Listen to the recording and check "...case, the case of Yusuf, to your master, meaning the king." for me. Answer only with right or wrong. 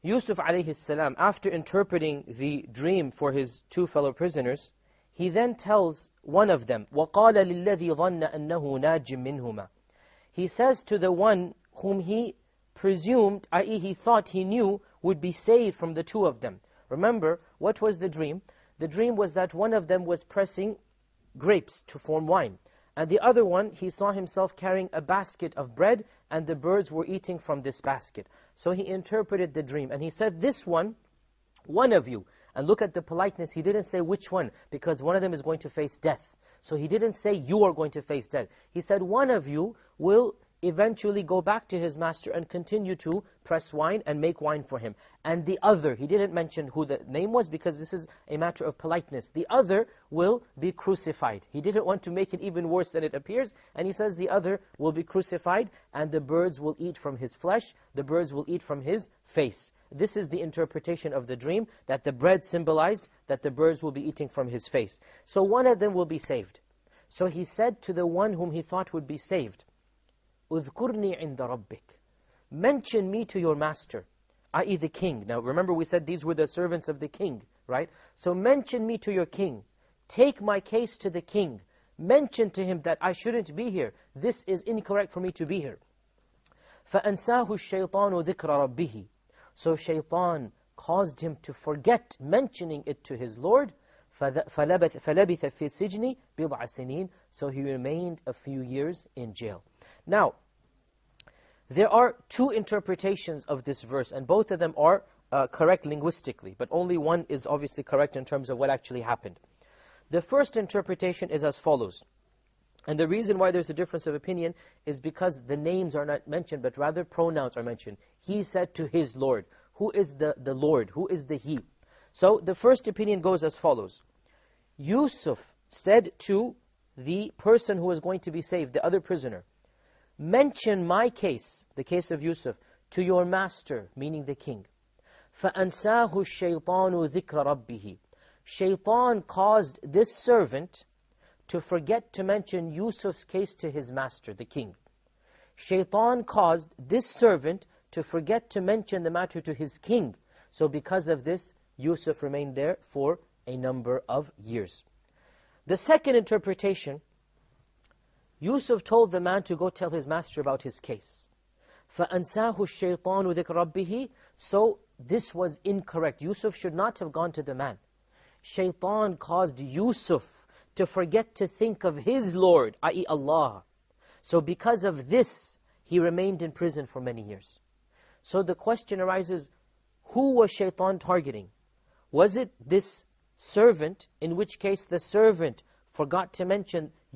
right.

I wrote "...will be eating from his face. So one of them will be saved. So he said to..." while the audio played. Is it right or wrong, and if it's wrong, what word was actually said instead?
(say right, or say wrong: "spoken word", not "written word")
right.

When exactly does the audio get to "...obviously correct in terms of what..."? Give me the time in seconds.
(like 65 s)
107 s.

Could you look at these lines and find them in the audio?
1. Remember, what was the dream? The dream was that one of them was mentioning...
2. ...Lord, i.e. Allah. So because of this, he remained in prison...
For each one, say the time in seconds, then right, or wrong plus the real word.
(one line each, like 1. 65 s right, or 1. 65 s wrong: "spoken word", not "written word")
1. 16 s wrong: "pressing", not "mentioning"
2. 172 s right.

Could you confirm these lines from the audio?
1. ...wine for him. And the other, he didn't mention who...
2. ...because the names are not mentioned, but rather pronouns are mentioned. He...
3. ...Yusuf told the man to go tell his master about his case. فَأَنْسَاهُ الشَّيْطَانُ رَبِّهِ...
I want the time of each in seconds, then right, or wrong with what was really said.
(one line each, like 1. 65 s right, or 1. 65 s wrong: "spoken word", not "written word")
1. 44 s right
2. 114 s right
3. 158 s right.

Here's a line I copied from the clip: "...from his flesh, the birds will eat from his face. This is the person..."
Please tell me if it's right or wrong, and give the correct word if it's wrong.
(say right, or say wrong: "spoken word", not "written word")
wrong: "interpretation", not "person".